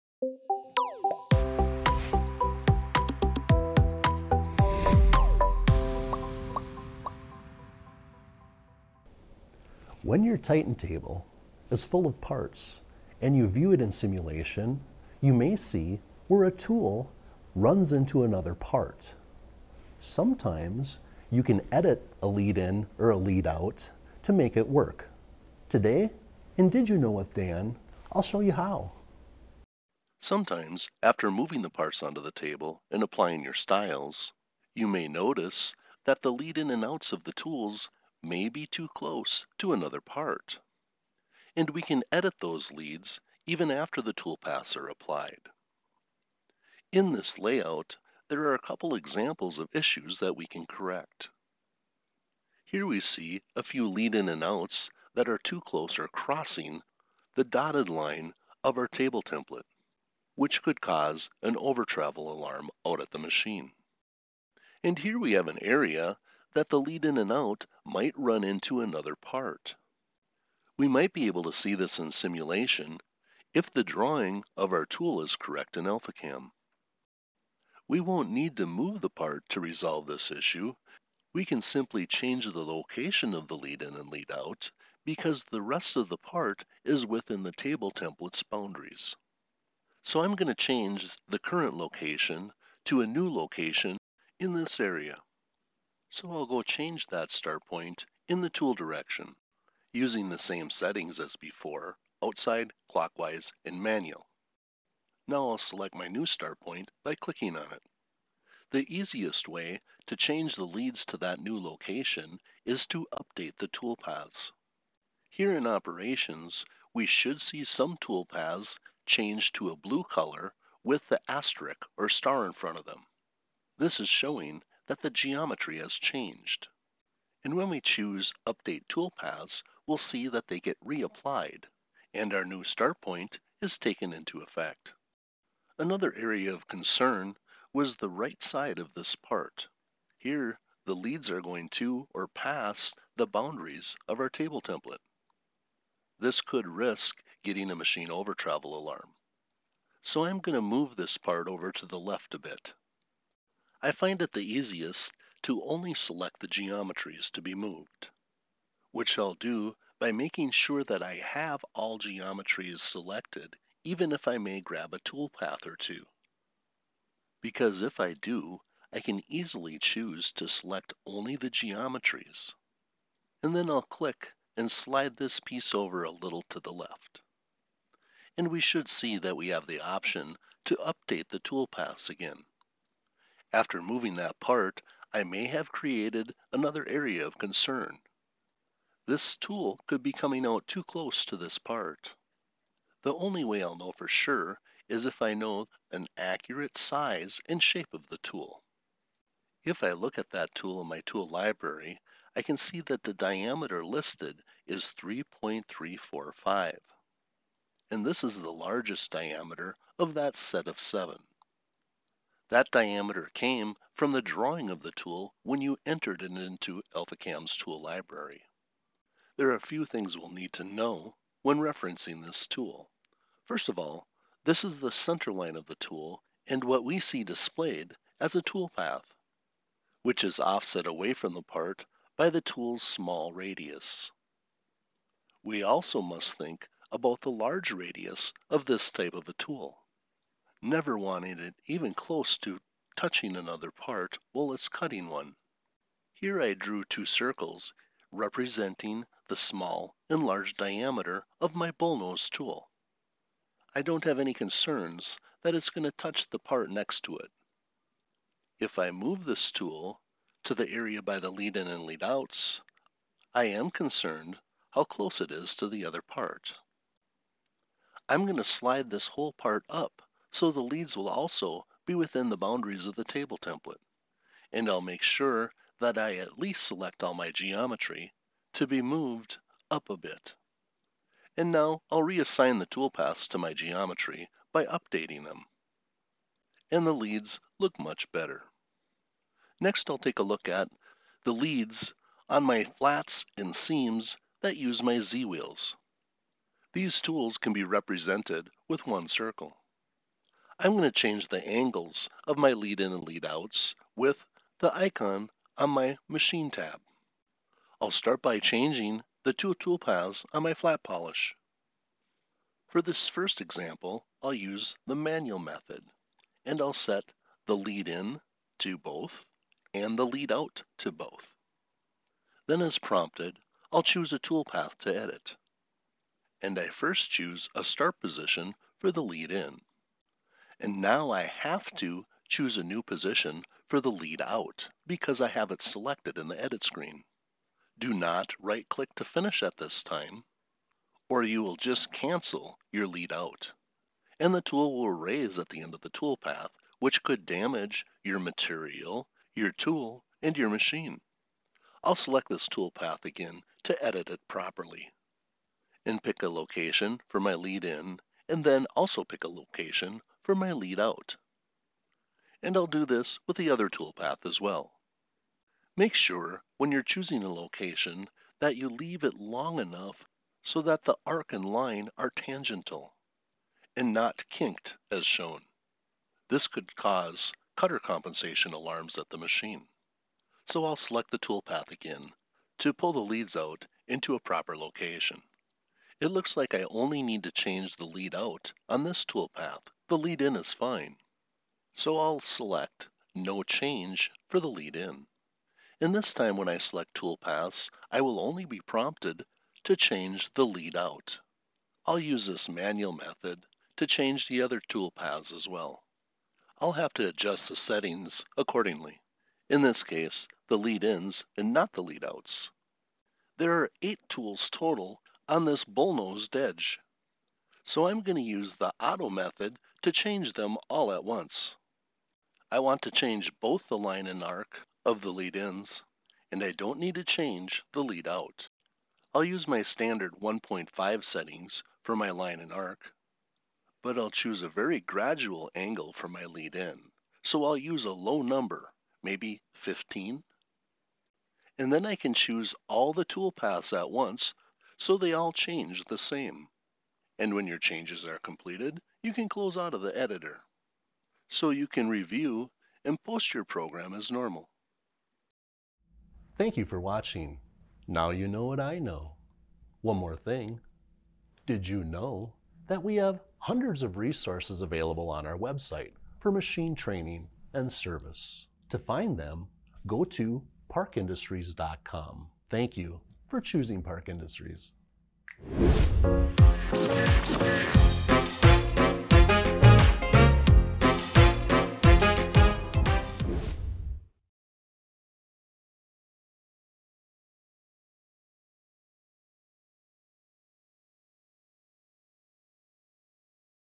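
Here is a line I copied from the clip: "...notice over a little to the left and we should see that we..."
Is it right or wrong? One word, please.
wrong.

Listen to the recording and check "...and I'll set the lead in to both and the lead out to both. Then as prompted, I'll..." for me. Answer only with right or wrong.
right.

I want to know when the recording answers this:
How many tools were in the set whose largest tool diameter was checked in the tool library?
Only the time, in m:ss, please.
3:30.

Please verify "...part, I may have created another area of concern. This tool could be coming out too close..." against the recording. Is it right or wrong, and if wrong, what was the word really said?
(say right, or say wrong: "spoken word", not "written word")
right.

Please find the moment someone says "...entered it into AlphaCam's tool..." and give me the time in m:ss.
3:35.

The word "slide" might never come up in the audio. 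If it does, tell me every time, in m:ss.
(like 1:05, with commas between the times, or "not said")
2:54, 4:28.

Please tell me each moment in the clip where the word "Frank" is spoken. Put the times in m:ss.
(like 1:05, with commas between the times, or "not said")
not said.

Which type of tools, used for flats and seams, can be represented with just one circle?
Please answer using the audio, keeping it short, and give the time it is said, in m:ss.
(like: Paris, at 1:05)
Z-wheels, at 4:54.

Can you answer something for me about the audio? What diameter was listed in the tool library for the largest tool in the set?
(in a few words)
3.345.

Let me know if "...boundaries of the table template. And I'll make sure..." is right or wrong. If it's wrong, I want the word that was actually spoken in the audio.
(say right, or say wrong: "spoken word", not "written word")
right.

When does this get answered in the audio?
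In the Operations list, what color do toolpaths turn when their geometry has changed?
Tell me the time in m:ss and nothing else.
1:59.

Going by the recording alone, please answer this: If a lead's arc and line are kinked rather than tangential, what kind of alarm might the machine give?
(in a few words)
cutter compensation alarms.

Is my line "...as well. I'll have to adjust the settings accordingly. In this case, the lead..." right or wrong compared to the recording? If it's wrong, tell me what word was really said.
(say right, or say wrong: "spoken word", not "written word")
right.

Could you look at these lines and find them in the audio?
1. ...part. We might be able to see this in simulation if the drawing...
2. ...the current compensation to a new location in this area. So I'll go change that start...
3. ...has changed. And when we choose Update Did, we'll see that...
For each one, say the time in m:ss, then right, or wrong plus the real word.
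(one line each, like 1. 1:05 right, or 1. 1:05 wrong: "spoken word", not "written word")
1. 1:09 right
2. 1:31 wrong: "location", not "compensation"
3. 2:05 wrong: "Toolpaths", not "Did".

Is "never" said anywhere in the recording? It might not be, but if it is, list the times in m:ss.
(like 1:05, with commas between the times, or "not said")
4:00.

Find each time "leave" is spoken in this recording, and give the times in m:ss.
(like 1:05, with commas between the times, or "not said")
6:08.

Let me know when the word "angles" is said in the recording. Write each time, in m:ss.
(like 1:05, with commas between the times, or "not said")
5:01, 7:15.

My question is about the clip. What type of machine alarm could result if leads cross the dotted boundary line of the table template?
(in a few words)
overtravel alarm.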